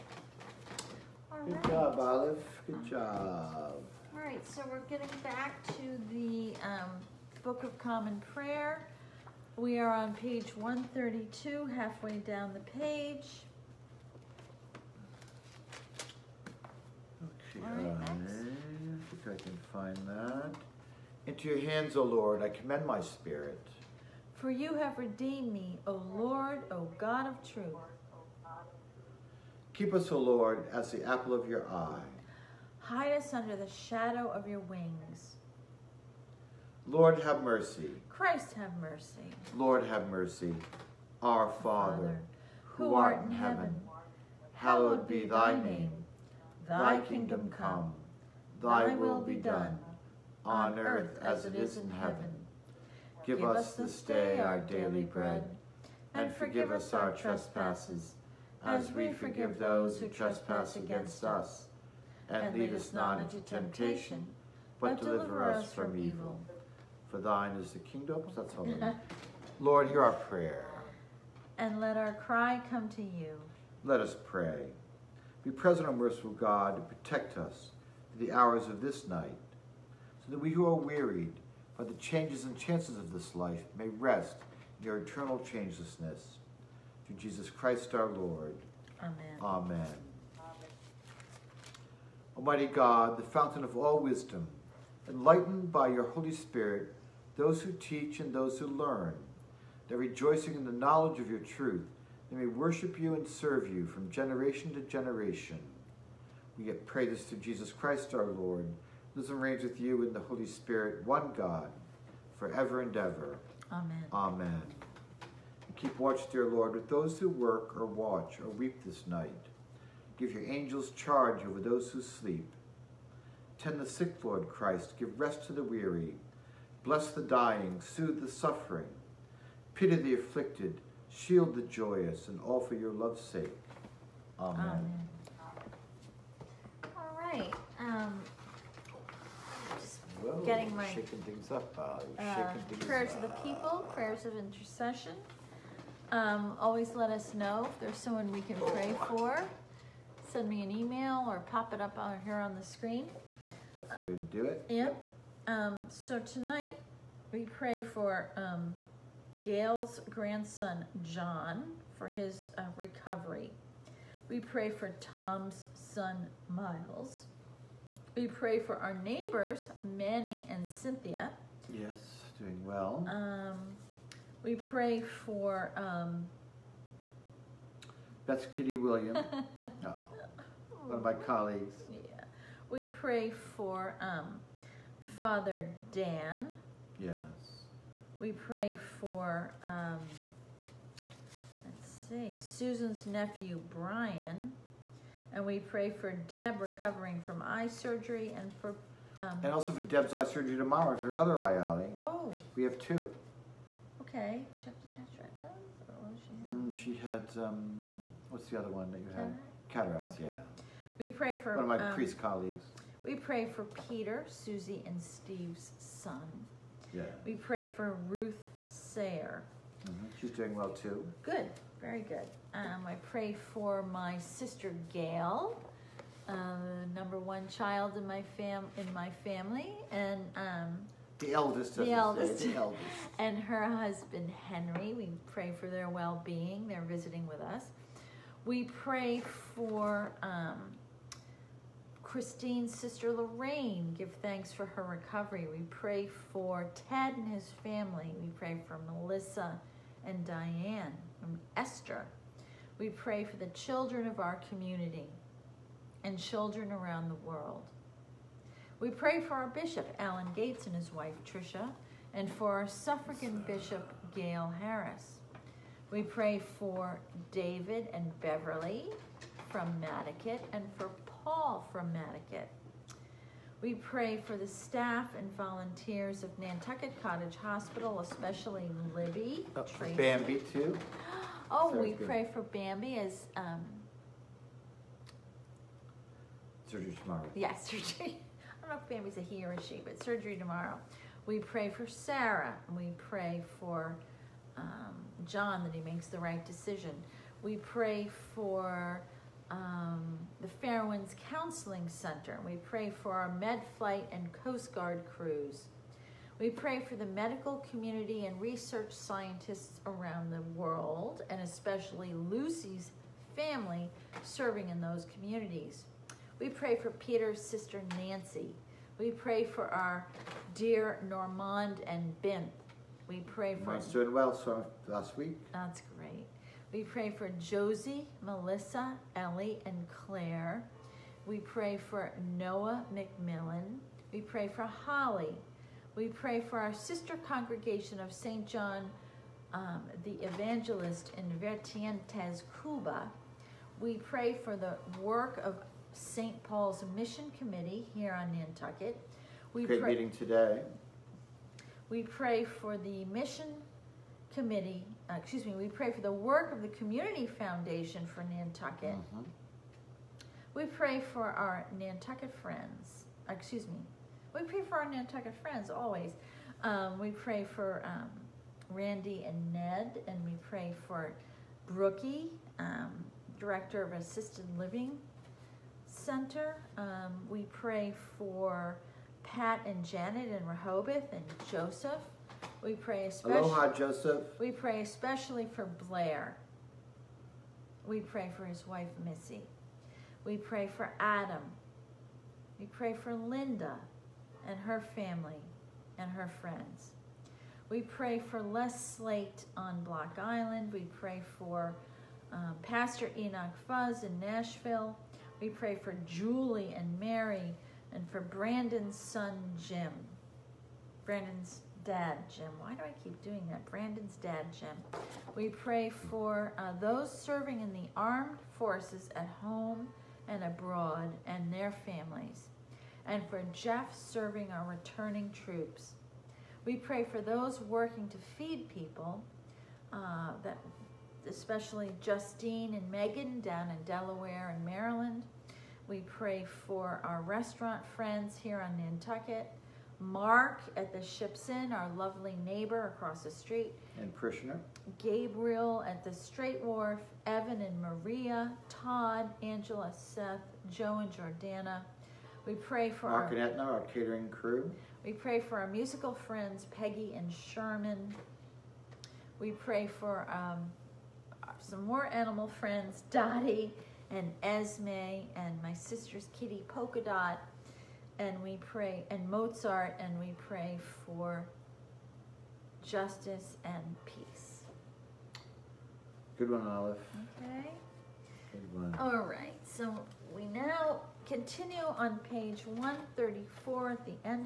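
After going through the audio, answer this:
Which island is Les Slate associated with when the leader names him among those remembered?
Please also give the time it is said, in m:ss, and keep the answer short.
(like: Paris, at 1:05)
Block Island, at 6:39.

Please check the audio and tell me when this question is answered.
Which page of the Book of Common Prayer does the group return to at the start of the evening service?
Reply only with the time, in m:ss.
0:10.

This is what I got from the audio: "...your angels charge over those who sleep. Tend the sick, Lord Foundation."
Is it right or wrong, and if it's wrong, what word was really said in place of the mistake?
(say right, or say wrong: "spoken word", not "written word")
wrong: "Christ", not "Foundation".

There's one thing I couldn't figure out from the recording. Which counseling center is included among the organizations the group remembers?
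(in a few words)
Fairwinds Counseling Center.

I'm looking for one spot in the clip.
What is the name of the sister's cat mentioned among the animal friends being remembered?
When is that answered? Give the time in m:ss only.
7:46.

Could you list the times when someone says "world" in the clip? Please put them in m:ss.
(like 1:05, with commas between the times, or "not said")
4:17, 5:10.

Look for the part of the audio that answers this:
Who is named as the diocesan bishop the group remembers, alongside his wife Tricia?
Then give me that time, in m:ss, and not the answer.
4:19.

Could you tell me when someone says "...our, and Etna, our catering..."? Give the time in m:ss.
7:33.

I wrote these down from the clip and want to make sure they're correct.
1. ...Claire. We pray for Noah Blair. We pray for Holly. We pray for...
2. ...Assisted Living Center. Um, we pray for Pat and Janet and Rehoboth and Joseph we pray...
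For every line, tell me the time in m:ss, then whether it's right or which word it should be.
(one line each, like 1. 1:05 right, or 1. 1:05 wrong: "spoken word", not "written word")
1. 5:29 wrong: "McMillan", not "Blair"
2. 6:13 right.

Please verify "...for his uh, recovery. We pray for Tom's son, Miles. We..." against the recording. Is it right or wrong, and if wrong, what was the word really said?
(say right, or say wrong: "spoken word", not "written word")
right.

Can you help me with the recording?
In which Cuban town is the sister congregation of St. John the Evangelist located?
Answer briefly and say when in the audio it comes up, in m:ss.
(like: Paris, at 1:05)
Vertientes, at 5:41.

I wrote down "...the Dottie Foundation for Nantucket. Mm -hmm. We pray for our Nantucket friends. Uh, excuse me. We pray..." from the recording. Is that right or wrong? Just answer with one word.
wrong.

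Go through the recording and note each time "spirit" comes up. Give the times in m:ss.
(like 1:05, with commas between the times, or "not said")
0:22, 1:36, 1:50.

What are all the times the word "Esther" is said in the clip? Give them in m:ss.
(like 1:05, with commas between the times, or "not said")
4:11.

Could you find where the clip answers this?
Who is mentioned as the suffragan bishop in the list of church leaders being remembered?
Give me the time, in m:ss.
4:24.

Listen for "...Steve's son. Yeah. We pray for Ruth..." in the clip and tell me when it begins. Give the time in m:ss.
3:35.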